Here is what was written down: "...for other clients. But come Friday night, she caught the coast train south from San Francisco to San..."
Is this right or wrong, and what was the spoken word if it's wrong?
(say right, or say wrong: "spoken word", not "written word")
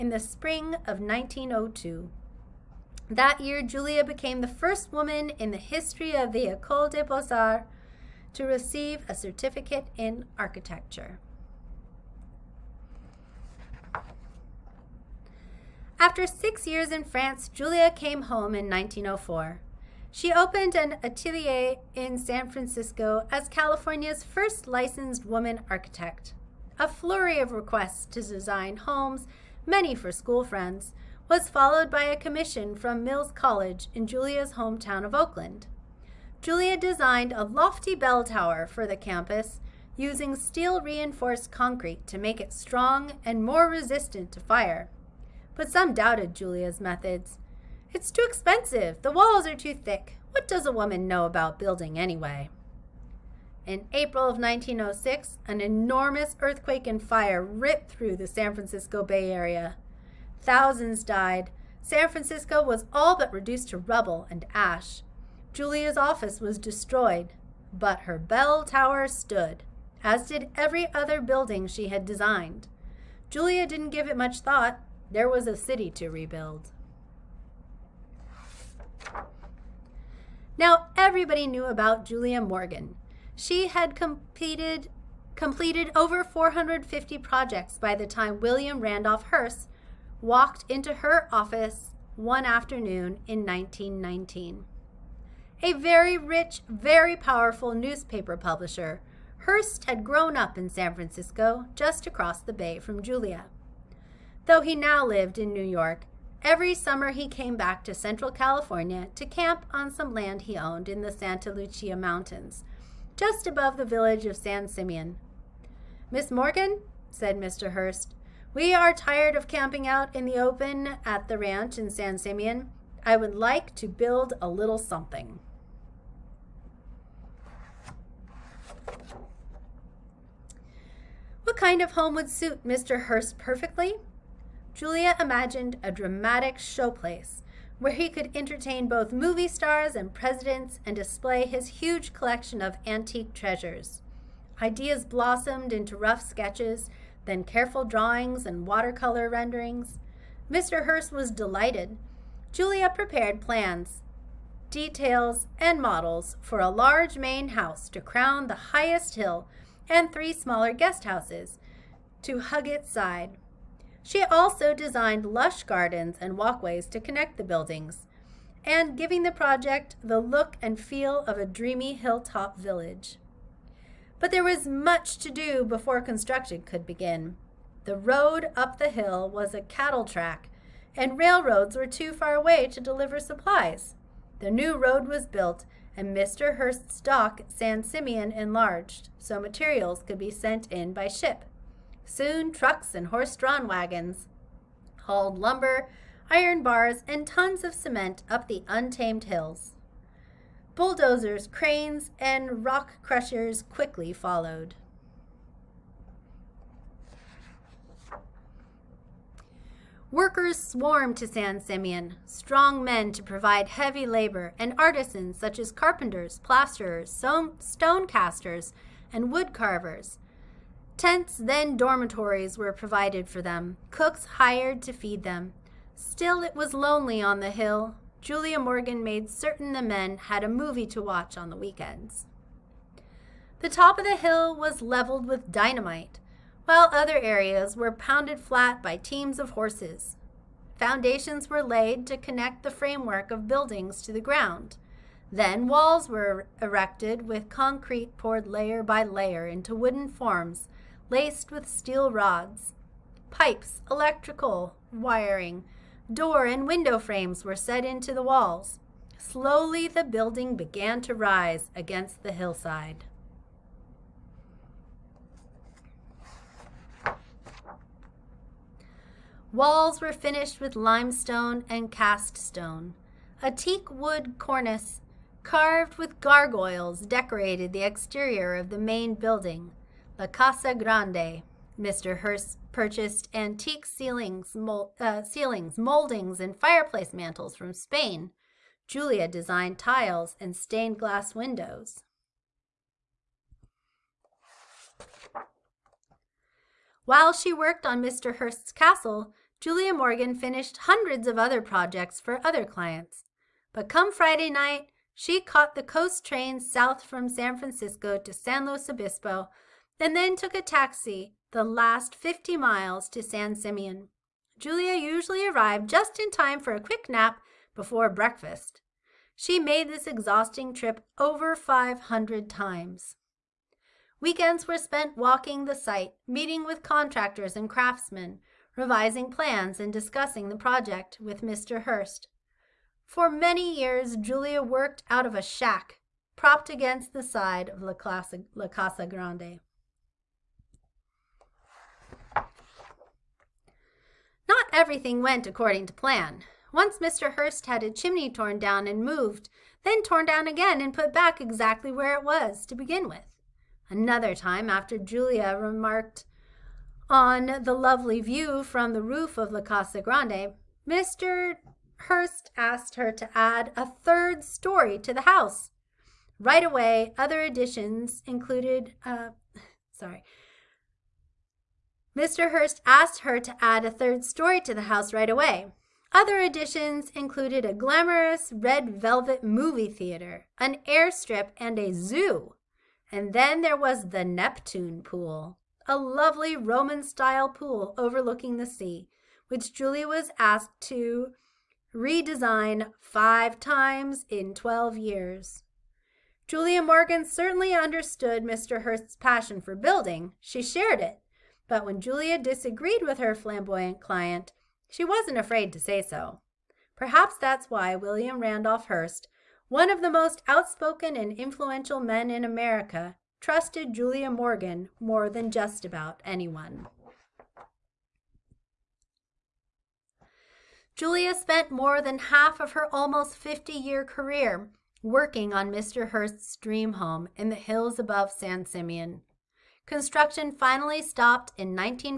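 right.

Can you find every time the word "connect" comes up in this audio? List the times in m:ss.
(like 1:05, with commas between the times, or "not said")
2:47, 4:02.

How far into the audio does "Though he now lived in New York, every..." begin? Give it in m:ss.
1:44.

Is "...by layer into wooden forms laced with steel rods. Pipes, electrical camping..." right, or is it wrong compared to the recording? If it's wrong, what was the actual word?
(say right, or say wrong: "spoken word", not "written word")
wrong: "wiring", not "camping".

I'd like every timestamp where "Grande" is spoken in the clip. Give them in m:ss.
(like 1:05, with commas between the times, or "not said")
4:40, 5:39, 6:00.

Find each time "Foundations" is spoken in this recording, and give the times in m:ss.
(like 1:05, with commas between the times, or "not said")
4:00.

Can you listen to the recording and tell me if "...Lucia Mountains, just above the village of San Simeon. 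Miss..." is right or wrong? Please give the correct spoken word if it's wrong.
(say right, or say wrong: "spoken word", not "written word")
right.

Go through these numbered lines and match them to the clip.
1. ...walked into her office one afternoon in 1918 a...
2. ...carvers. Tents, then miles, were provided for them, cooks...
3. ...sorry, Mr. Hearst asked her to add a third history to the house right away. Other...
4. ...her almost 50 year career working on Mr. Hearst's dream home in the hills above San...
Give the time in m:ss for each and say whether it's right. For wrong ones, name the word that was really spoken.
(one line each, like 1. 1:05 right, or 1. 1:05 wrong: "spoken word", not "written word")
1. 1:30 wrong: "1919", not "1918"
2. 3:39 wrong: "dormitories", not "miles"
3. 6:09 wrong: "story", not "history"
4. 7:02 right.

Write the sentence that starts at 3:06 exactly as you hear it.
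Hearst's dock, San Simeon enlarged, so materials could be sent in by ship.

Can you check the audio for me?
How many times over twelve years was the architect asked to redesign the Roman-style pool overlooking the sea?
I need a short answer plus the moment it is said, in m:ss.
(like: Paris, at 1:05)
5, at 6:33.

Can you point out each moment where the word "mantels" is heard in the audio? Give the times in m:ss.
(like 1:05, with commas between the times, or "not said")
4:47.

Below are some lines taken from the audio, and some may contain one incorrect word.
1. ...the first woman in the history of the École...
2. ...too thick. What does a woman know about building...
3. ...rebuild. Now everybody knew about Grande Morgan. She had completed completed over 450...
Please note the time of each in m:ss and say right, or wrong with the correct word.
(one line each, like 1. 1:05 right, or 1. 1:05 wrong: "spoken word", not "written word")
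1. 0:04 right
2. 0:49 right
3. 1:16 wrong: "Julia", not "Grande".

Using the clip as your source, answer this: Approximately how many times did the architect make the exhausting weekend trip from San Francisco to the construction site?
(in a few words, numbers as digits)
over 500.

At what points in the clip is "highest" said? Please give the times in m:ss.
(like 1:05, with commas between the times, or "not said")
2:38.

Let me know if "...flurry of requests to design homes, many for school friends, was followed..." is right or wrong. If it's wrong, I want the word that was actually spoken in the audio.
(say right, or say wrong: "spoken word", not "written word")
right.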